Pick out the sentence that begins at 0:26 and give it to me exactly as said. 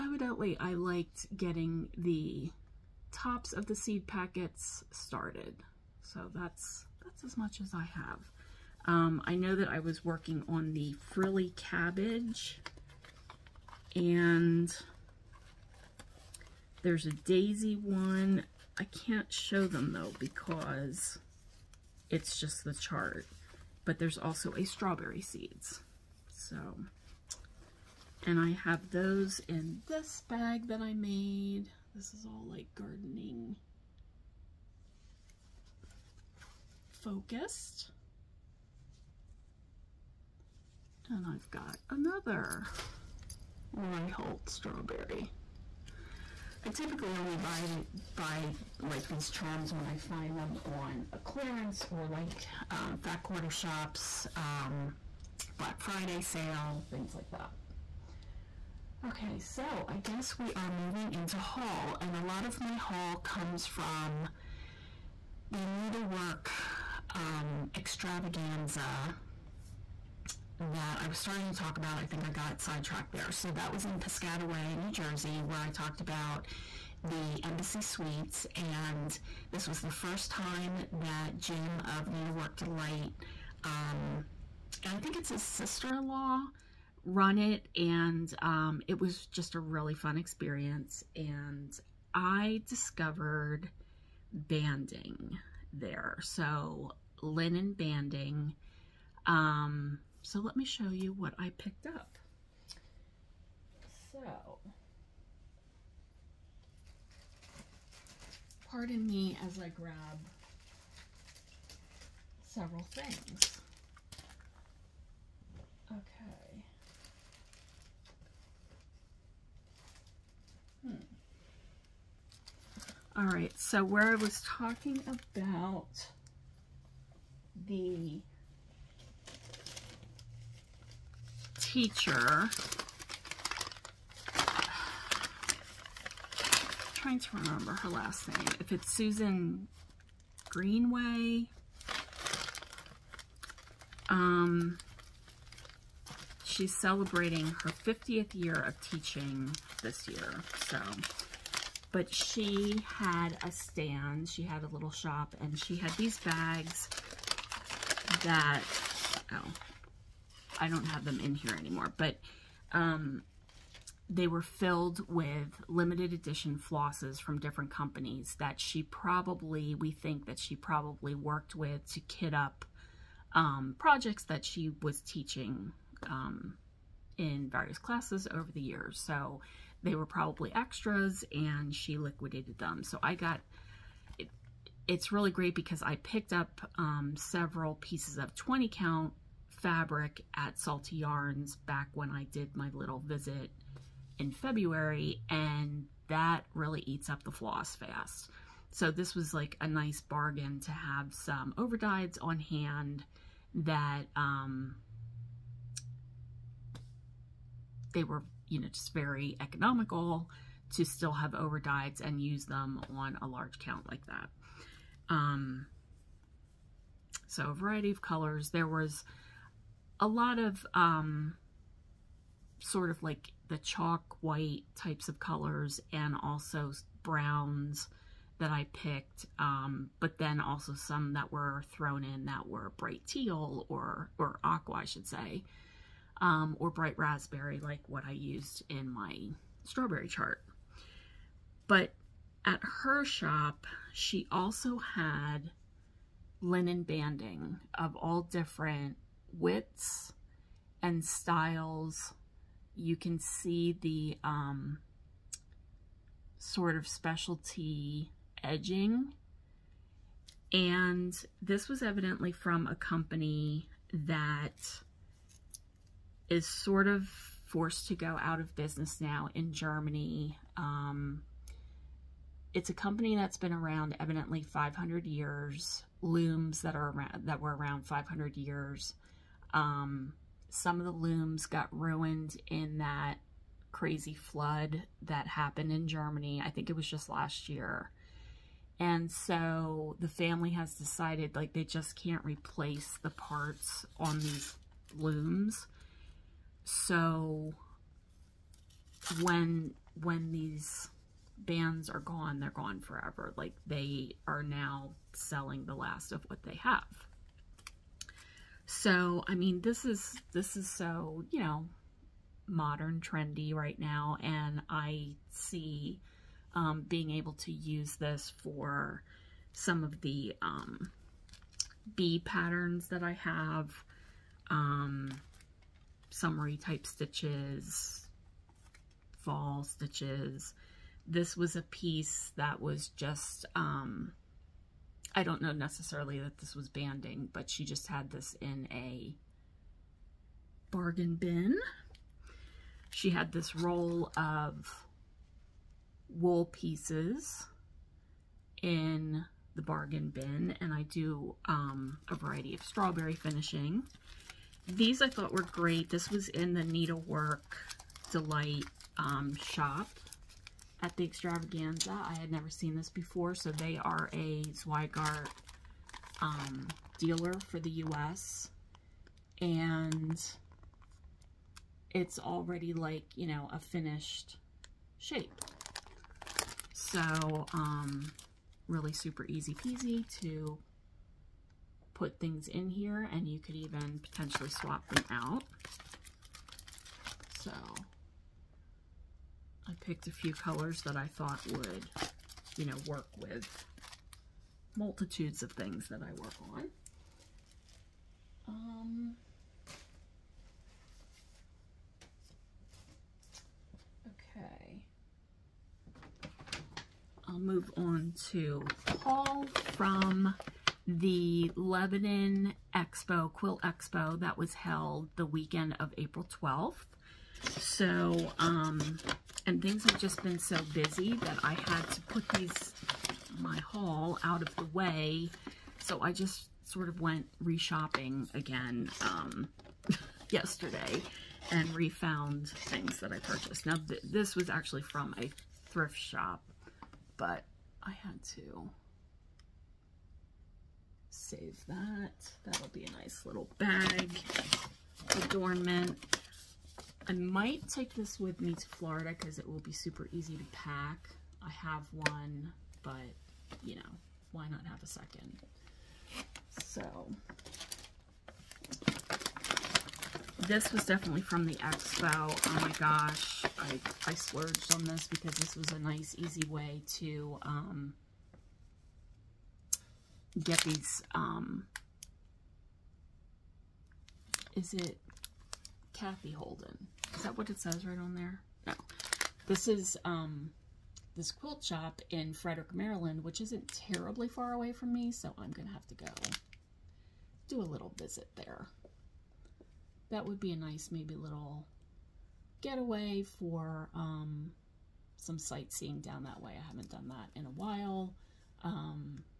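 So, and I have those in this bag that I made.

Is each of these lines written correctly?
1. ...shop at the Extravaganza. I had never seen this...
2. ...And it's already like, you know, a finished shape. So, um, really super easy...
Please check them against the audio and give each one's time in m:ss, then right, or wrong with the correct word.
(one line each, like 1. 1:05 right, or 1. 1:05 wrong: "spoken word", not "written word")
1. 5:59 right
2. 6:09 right.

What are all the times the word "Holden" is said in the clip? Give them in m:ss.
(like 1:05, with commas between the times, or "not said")
7:56.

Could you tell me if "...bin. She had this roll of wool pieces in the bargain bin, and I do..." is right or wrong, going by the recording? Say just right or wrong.
right.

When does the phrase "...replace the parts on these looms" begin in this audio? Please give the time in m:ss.
4:52.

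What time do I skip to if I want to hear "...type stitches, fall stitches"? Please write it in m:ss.
5:26.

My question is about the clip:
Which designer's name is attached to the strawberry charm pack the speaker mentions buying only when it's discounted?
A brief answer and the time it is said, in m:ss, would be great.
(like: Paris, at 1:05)
Lori Holt, at 0:43.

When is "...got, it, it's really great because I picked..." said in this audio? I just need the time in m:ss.
3:03.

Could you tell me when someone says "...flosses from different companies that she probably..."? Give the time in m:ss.
2:46.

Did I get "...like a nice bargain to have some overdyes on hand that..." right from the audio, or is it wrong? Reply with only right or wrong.
right.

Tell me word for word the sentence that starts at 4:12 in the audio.
You can see the um, sort of specialty edging.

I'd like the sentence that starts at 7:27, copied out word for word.
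I might take this with me to Florida because it will be super easy to pack.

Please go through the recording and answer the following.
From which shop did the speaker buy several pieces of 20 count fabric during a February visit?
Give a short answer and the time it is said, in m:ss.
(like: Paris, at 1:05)
Salty Yarns, at 3:10.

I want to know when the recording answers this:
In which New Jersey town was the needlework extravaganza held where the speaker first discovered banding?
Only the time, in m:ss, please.
1:13.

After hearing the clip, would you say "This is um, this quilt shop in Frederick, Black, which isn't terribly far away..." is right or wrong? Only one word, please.
wrong.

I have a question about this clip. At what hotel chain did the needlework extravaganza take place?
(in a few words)
Embassy Suites.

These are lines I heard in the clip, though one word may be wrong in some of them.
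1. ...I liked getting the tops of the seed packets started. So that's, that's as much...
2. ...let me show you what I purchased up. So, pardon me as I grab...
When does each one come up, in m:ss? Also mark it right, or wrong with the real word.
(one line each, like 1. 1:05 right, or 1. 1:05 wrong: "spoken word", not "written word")
1. 0:00 right
2. 1:40 wrong: "picked", not "purchased".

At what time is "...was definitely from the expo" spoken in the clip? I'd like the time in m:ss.
7:40.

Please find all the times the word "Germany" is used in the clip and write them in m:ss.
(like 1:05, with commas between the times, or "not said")
4:29, 4:45.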